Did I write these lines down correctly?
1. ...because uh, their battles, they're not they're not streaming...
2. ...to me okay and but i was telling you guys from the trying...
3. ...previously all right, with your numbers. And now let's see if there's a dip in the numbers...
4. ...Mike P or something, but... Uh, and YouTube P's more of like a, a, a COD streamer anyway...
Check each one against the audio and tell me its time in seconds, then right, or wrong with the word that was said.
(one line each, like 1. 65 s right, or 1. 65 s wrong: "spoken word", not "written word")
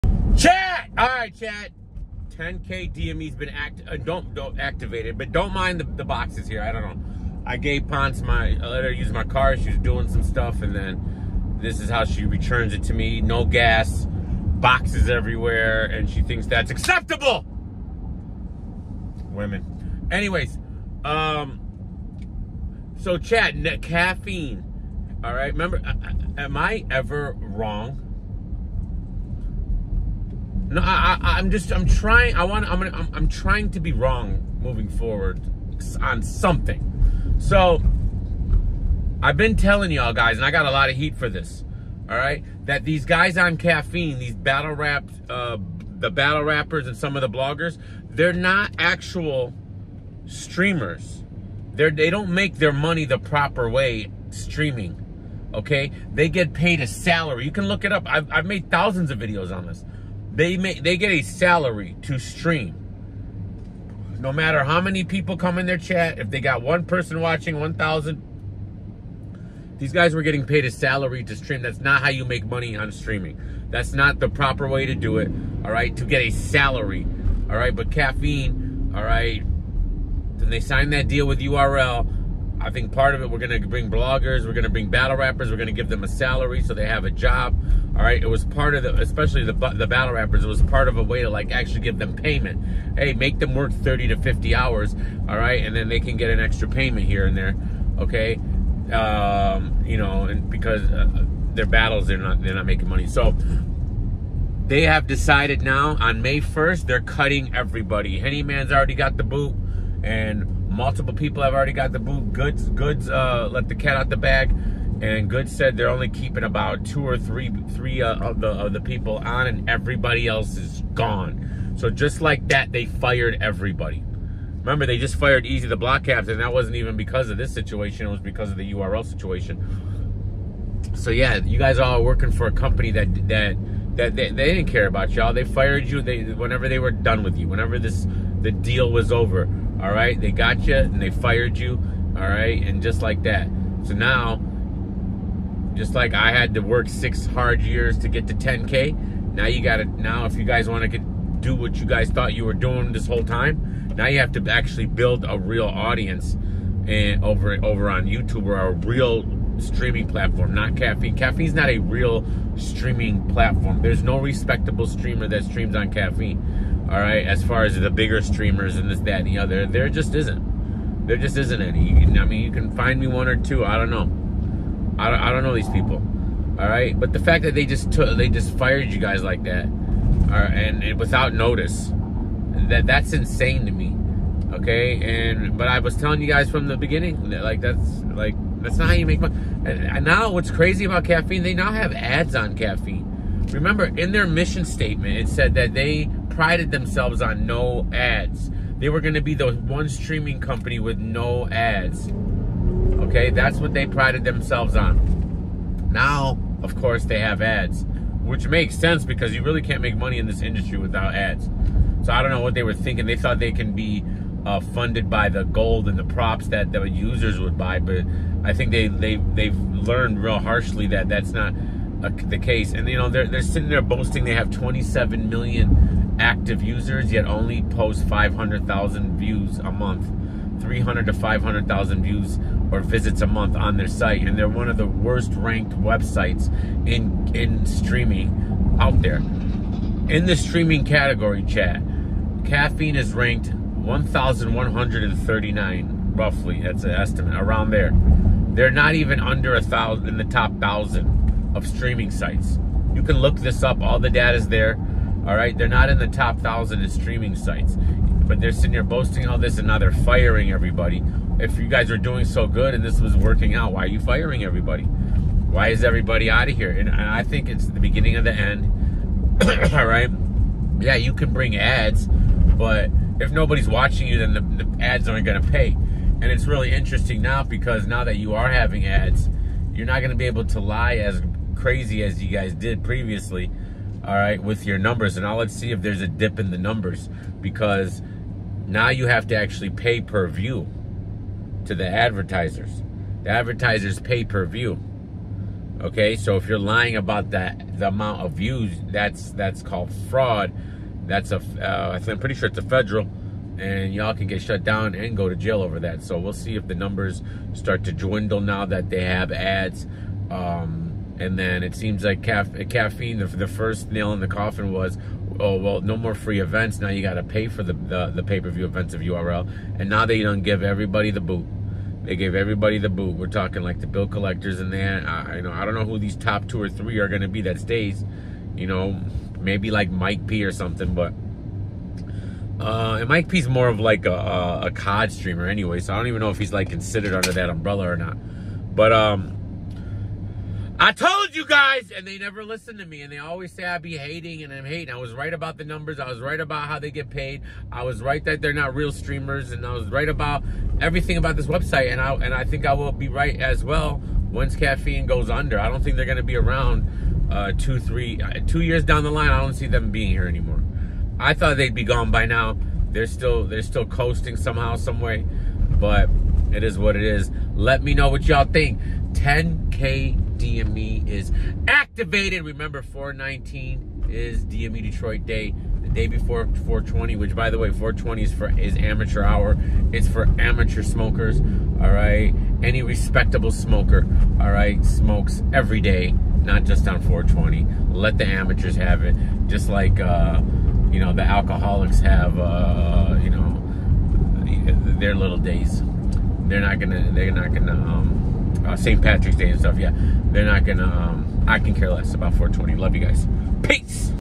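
1. 100 s wrong: "making", not "streaming"
2. 183 s wrong: "beginning", not "trying"
3. 282 s right
4. 329 s wrong: "Mike", not "YouTube".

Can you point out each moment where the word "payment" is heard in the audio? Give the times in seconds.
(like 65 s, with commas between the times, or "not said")
92 s, 96 s.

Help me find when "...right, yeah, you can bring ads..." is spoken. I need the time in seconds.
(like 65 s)
269 s.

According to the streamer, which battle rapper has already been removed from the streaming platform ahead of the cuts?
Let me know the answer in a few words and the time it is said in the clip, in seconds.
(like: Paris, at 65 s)
Henny Man, at 108 s.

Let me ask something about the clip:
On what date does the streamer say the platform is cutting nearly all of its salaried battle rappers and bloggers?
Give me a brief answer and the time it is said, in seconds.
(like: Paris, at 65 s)
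May 1st, at 106 s.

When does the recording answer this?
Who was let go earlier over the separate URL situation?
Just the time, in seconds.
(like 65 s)
125 s.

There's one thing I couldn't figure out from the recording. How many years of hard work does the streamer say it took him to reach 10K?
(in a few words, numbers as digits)
6.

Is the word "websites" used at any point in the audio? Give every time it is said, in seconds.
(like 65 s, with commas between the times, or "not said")
235 s, 351 s.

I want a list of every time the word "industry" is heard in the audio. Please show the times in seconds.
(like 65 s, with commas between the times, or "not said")
210 s.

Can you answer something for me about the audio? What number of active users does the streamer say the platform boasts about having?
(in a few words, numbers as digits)
27 million.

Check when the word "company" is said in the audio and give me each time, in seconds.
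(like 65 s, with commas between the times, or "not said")
132 s, 200 s.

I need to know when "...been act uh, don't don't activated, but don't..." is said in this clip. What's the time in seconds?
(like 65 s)
3 s.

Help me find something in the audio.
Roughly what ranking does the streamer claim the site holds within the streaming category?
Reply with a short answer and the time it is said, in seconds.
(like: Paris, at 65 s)
1,139, at 243 s.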